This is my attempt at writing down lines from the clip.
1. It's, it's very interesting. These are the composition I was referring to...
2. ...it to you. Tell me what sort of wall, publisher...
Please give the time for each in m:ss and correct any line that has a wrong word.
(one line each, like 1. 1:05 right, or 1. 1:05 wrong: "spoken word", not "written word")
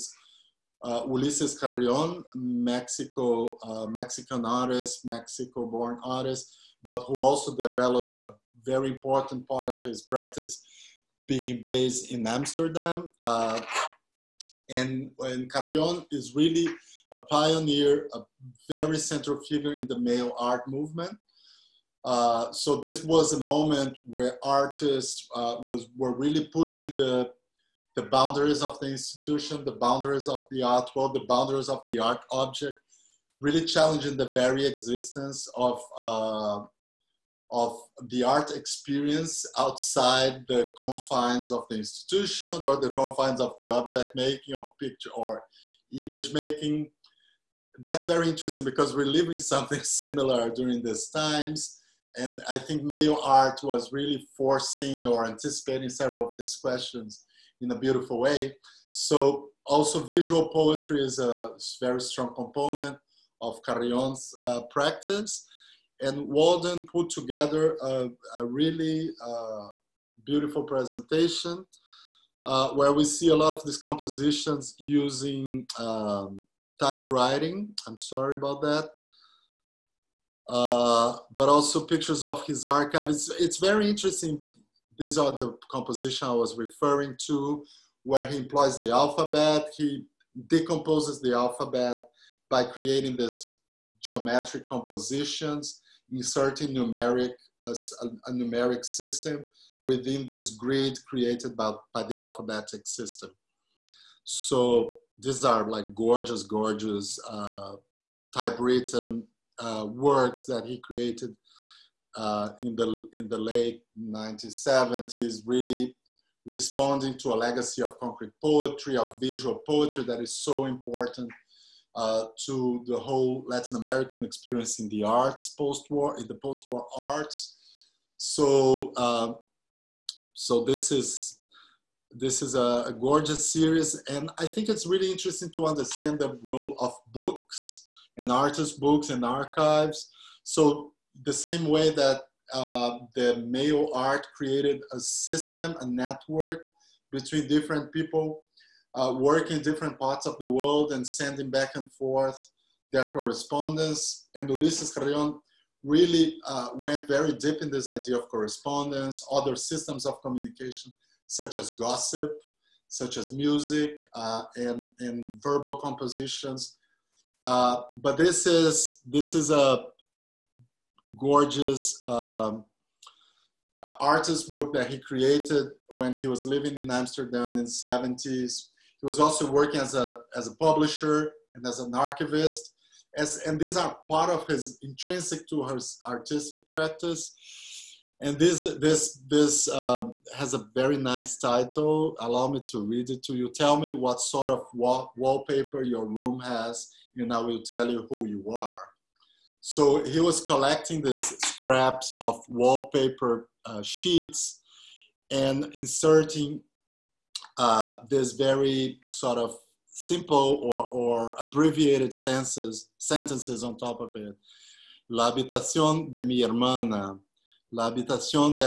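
1. 1:23 right
2. 3:13 wrong: "wallpaper", not "publisher".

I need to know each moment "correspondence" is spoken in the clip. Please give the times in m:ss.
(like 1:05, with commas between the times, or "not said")
2:33, 2:38.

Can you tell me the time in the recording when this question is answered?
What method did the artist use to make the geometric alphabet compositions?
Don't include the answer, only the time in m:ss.
1:16.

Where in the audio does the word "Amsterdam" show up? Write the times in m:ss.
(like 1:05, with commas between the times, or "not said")
0:12, 2:56.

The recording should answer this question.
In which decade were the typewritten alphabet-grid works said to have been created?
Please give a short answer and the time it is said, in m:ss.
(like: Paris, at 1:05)
late 1970s, at 1:53.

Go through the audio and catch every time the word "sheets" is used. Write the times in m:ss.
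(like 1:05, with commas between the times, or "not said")
3:23.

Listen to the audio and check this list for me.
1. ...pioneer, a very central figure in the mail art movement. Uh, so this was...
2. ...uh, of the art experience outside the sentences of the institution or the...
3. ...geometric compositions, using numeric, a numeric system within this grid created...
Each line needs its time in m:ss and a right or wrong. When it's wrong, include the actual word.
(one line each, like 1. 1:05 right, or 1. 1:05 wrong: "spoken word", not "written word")
1. 0:17 right
2. 0:35 wrong: "confines", not "sentences"
3. 1:34 wrong: "inserting", not "using".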